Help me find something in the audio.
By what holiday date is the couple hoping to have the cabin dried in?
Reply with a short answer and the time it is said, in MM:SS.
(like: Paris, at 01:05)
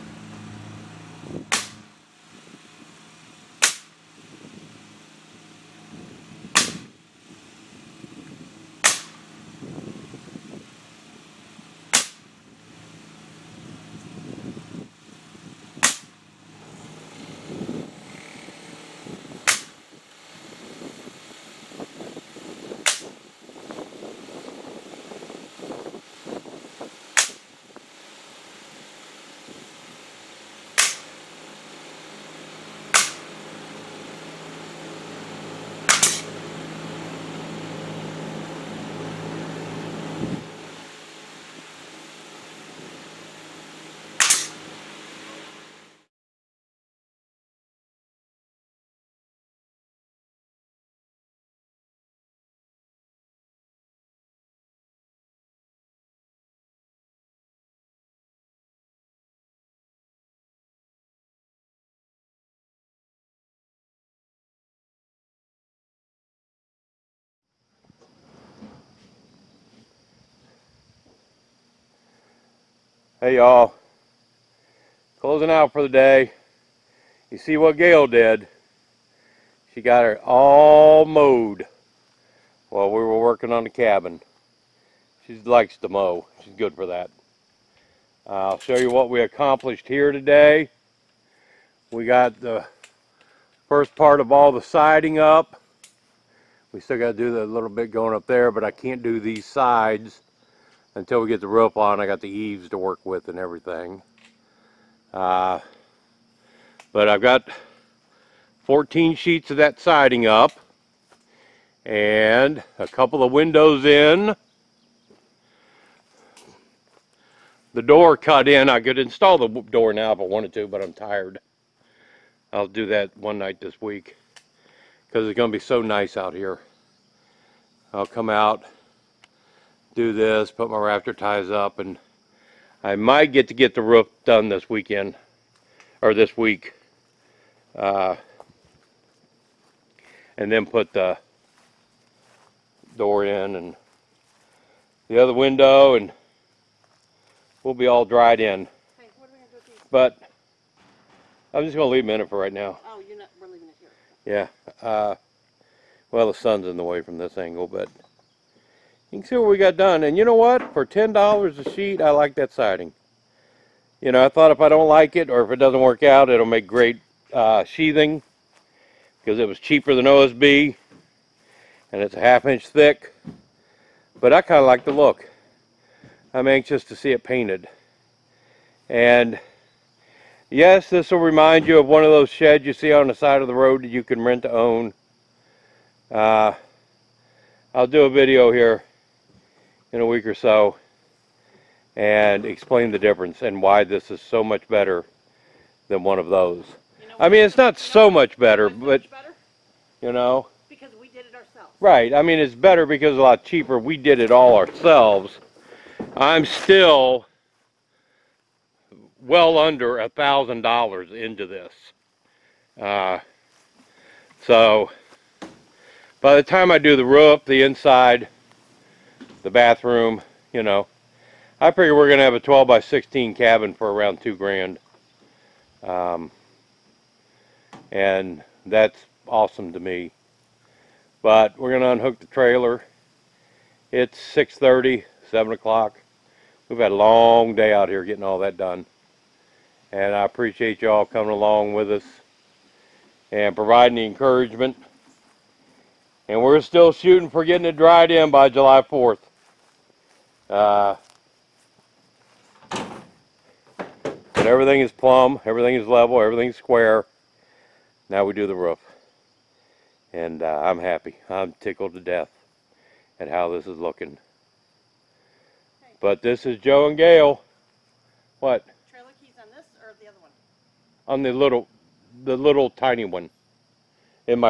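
July 4th, at 04:08.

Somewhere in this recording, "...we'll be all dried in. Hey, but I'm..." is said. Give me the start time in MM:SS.
02:27.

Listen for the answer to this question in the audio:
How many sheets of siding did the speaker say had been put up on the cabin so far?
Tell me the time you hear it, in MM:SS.
01:48.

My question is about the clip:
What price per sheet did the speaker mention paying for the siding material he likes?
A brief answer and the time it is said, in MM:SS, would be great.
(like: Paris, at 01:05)
$10, at 02:40.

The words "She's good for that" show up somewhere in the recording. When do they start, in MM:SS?
01:26.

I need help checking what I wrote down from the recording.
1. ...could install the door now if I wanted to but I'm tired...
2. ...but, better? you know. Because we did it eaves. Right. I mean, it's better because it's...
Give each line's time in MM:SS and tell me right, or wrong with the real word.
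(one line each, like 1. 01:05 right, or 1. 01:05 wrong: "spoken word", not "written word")
1. 01:58 right
2. 03:18 wrong: "ourselves", not "eaves".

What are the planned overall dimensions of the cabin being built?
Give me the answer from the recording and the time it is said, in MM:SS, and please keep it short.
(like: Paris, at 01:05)
12 by 16, at 03:42.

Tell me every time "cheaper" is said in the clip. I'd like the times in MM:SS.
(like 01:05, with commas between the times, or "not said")
02:49, 03:23.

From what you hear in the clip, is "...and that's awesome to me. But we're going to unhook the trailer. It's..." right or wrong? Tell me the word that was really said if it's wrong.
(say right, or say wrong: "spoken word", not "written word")
right.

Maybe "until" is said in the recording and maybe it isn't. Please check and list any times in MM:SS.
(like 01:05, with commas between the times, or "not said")
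01:40.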